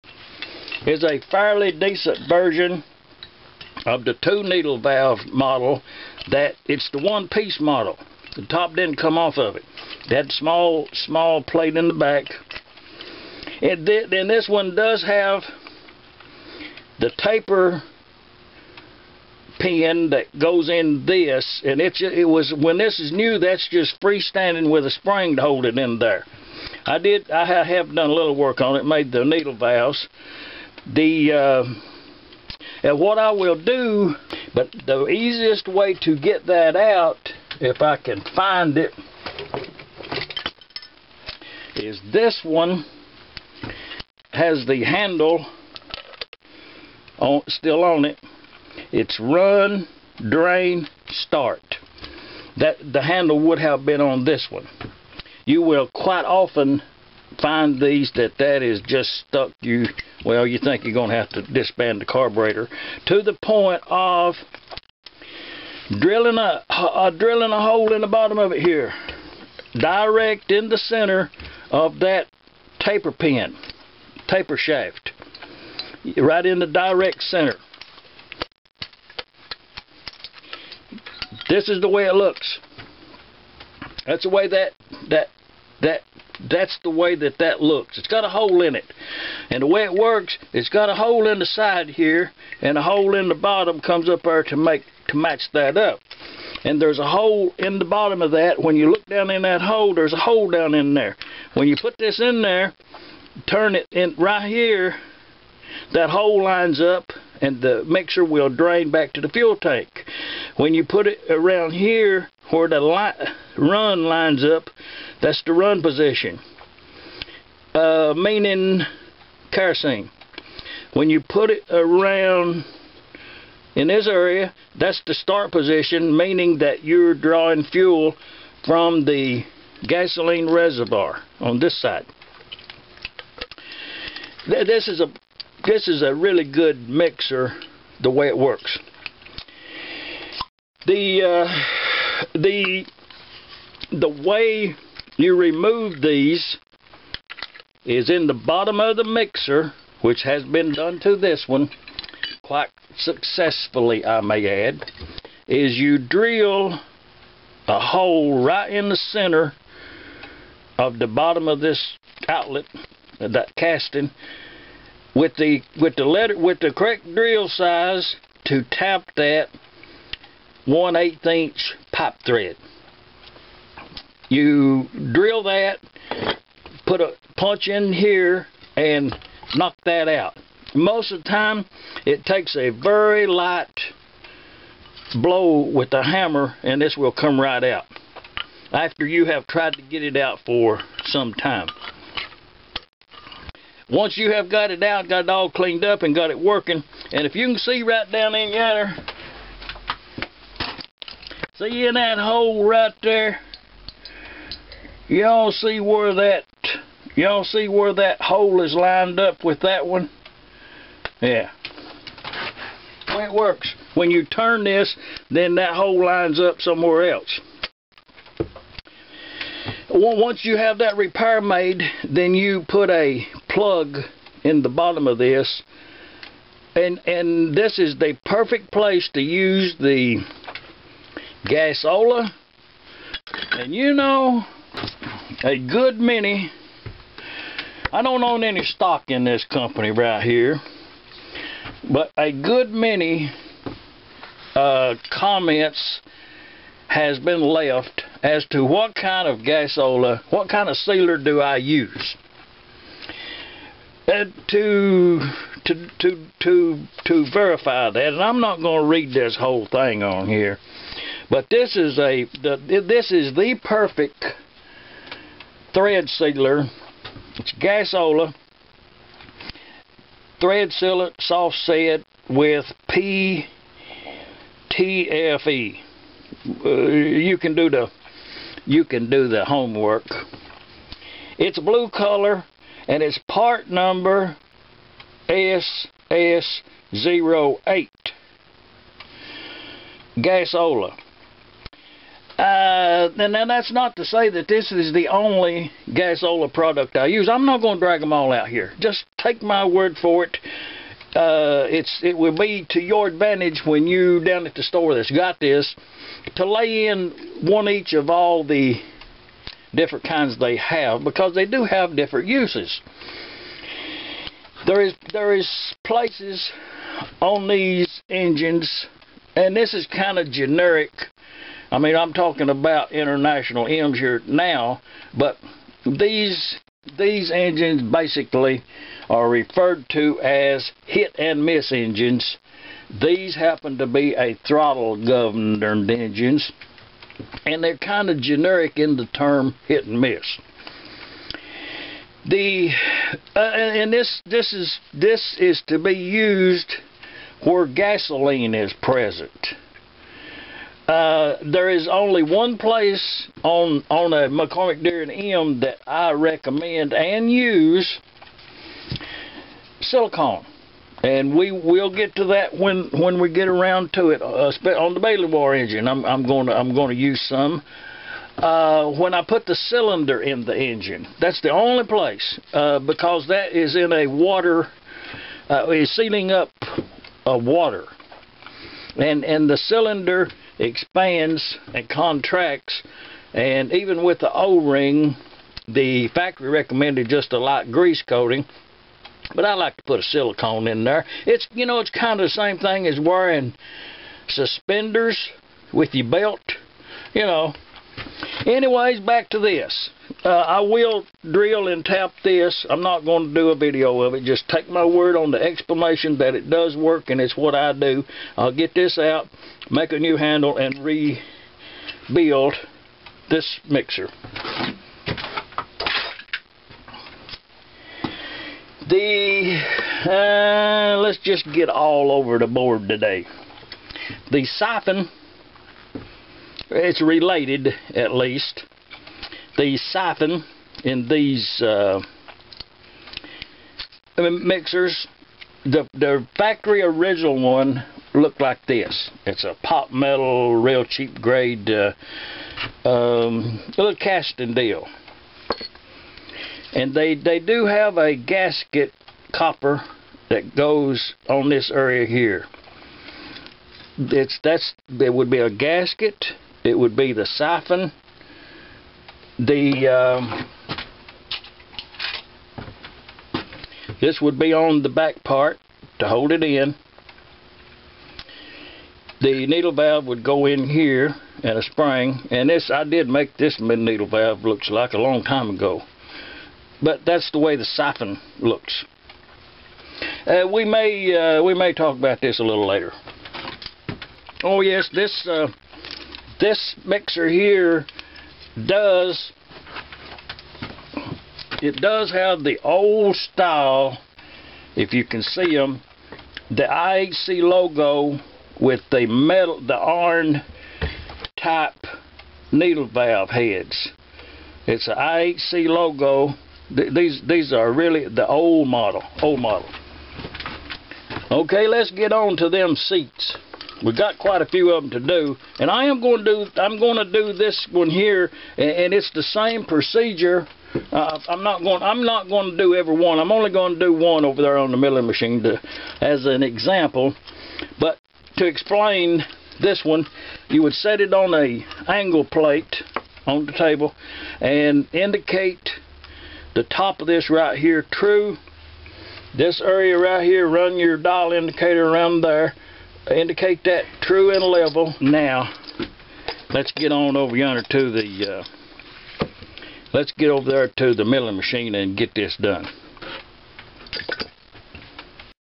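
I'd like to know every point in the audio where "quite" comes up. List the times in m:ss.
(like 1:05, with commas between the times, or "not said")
0:55, 2:32, 8:34.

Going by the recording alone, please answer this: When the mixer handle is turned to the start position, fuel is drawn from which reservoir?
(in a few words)
Gasoline reservoir.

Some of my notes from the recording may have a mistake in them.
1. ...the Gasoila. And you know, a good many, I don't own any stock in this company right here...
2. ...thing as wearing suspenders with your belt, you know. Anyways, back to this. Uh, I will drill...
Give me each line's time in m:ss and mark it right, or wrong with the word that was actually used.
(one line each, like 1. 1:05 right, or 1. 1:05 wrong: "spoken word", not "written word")
1. 3:49 right
2. 6:32 right.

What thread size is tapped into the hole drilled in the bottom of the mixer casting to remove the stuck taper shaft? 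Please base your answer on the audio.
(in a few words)
1/8 inch pipe thread.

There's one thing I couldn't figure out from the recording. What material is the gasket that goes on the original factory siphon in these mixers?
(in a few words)
Copper.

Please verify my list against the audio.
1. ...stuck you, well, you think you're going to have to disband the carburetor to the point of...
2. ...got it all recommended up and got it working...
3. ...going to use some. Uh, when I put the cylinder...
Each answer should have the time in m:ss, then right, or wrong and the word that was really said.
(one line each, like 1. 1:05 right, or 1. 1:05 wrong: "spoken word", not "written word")
1. 0:59 right
2. 3:15 wrong: "cleaned", not "recommended"
3. 6:06 right.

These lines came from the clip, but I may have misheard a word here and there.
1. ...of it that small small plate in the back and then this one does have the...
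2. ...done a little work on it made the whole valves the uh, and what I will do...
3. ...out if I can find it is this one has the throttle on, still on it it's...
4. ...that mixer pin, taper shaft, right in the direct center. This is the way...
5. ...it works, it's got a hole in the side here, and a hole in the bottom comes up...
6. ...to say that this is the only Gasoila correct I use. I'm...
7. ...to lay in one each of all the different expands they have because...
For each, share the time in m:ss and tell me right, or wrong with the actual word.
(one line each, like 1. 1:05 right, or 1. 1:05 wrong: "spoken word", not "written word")
1. 0:09 right
2. 0:27 wrong: "needle", not "whole"
3. 0:36 wrong: "handle", not "throttle"
4. 1:11 wrong: "taper", not "mixer"
5. 1:29 right
6. 4:53 wrong: "product", not "correct"
7. 5:06 wrong: "kinds", not "expands".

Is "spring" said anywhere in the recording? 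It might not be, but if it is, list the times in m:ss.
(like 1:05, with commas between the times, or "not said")
0:24, 7:51.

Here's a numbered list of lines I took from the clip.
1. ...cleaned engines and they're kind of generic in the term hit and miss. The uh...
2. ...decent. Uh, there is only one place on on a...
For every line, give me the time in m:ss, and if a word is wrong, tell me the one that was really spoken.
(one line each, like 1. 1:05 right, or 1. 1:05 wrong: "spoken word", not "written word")
1. 5:35 wrong: "governed", not "cleaned"
2. 5:48 wrong: "present", not "decent".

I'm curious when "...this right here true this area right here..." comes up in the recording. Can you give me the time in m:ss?
8:57.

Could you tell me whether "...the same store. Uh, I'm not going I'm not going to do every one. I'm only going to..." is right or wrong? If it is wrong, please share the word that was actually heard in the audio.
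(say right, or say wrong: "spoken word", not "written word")
wrong: "procedure", not "store".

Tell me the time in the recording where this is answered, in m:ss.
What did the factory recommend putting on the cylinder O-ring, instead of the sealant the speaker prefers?
6:27.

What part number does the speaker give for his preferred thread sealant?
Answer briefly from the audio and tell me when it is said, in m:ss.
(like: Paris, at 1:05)
SS08, at 4:45.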